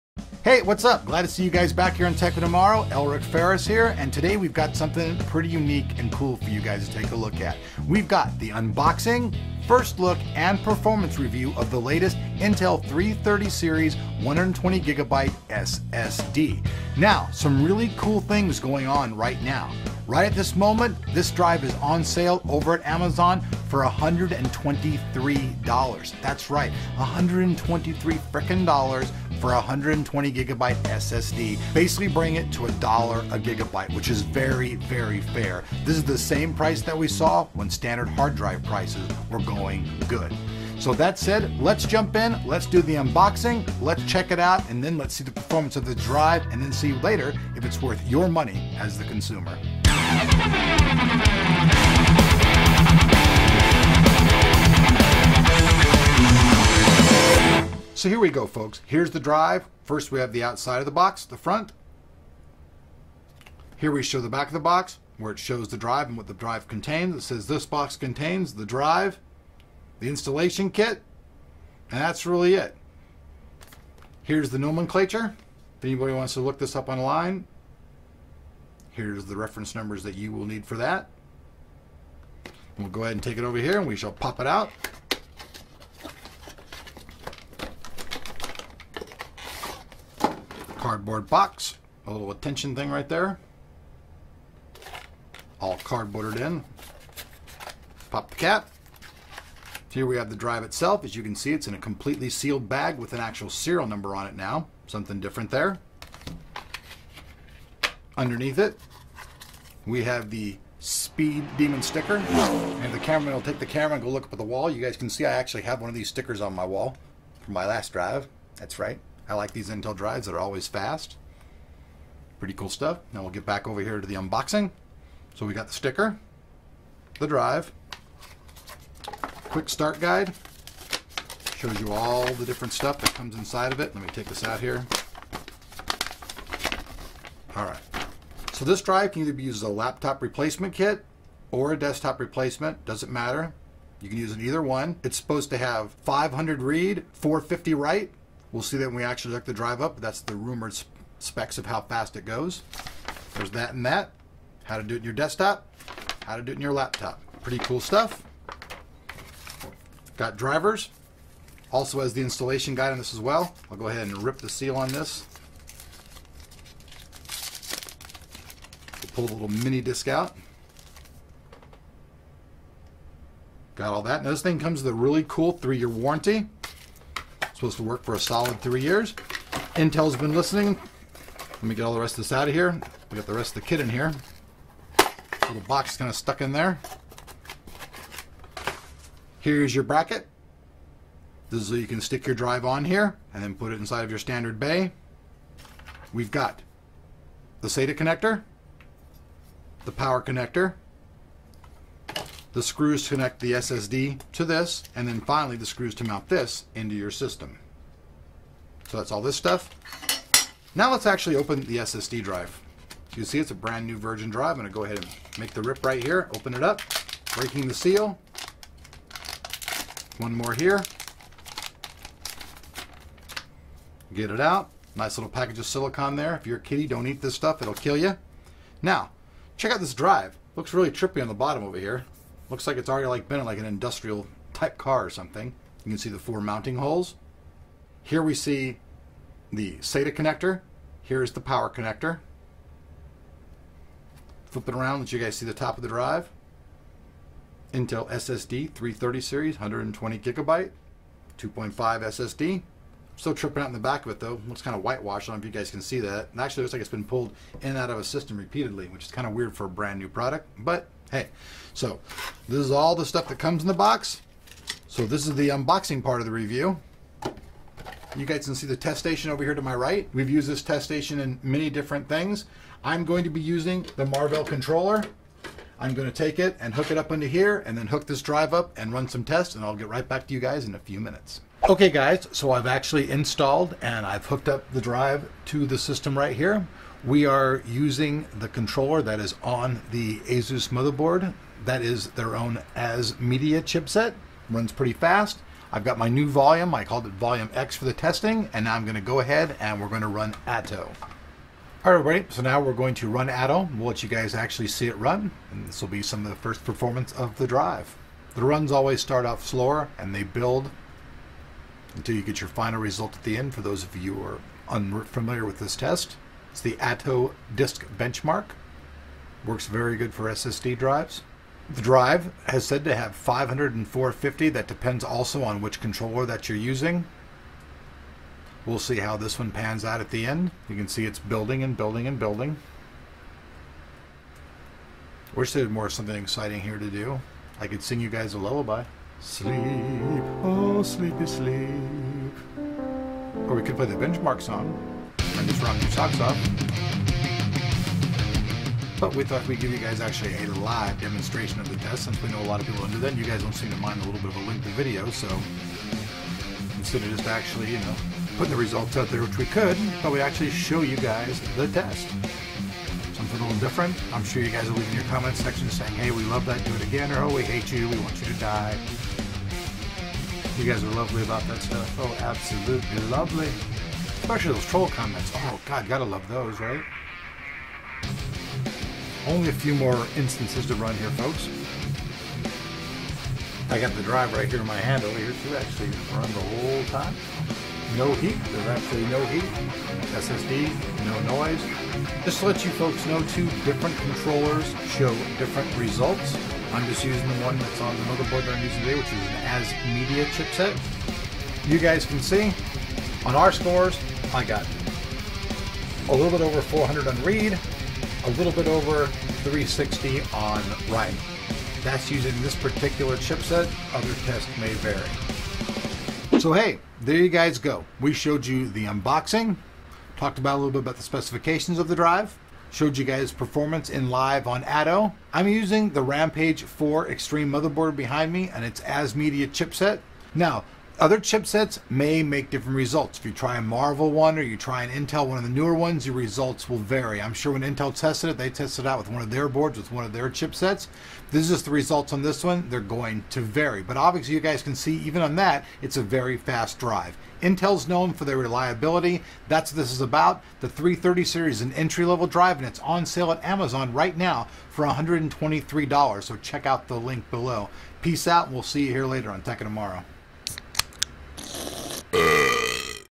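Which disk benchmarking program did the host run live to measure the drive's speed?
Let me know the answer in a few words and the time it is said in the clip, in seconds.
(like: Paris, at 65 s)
Atto Disk Benchmark, at 316 s.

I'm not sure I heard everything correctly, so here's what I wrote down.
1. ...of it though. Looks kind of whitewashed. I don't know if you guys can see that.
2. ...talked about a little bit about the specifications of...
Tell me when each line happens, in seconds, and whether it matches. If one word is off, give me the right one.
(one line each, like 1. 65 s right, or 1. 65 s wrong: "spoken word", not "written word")
1. 254 s right
2. 420 s right.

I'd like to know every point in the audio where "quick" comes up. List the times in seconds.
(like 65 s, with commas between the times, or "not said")
129 s.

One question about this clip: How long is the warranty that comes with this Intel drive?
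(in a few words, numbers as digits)
three years.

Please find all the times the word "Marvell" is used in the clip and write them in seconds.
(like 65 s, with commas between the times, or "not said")
274 s, 433 s.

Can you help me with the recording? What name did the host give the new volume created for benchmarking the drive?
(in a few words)
Volume X.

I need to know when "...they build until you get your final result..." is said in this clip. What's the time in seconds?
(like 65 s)
310 s.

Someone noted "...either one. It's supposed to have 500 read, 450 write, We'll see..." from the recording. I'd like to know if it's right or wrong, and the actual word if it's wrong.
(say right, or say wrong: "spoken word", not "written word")
right.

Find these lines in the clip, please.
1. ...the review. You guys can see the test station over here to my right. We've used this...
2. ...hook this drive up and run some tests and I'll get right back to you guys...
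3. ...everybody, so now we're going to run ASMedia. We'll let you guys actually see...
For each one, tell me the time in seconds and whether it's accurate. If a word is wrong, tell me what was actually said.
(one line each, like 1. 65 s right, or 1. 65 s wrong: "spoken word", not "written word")
1. 266 s right
2. 277 s right
3. 301 s wrong: "Atto", not "ASMedia".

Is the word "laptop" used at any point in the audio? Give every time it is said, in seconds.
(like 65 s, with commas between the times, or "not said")
139 s, 156 s.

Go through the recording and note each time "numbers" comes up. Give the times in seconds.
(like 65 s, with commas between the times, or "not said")
79 s, 103 s.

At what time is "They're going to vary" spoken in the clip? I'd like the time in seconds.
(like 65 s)
442 s.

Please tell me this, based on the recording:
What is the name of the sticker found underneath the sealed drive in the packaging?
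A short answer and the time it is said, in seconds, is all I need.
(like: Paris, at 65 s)
Speed Demon, at 110 s.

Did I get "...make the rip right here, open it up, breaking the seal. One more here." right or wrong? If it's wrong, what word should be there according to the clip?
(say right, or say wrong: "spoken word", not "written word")
right.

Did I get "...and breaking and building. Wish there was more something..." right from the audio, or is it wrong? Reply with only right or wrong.
wrong.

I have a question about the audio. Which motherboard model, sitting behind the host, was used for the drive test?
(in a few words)
Rampage 4 Extreme.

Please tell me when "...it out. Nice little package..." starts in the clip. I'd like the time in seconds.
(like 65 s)
224 s.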